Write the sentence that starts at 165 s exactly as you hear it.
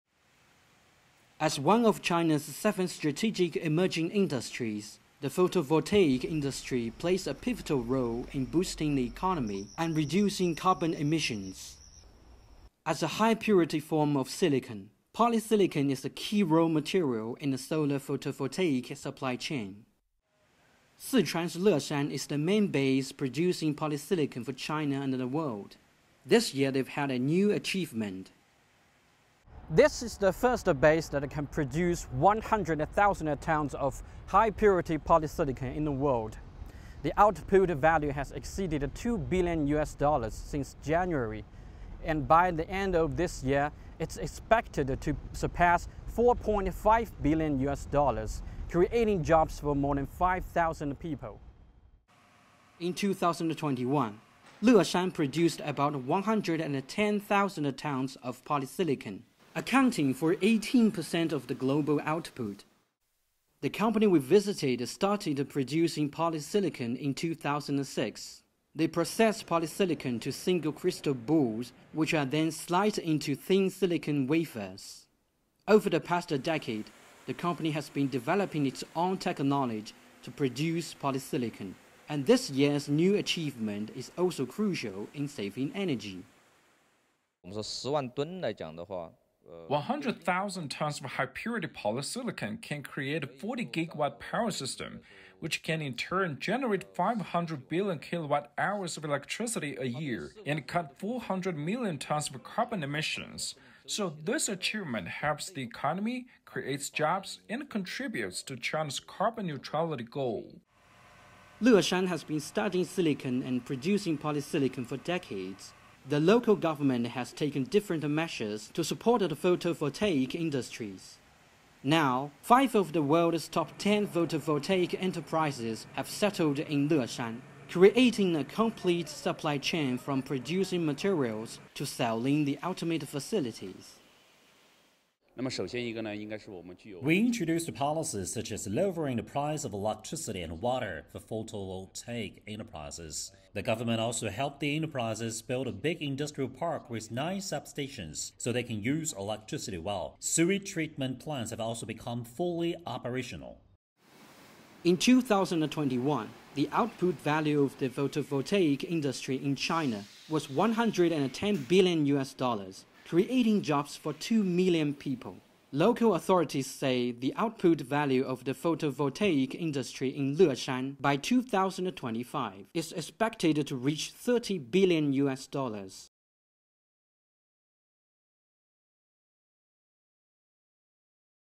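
Local authorities say the output value of the photovoltaic industry in Leshan by 2025 is expected to reach 30 billion US dollars.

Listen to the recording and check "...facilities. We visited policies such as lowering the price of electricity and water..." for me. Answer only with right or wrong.
wrong.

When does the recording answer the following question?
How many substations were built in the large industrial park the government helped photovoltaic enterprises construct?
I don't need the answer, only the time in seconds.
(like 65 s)
147 s.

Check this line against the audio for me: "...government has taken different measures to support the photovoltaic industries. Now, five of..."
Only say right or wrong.
right.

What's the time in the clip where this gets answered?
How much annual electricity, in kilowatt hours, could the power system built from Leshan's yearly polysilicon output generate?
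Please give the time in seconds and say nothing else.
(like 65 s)
96 s.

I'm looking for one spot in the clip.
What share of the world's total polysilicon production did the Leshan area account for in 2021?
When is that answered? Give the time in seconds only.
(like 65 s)
60 s.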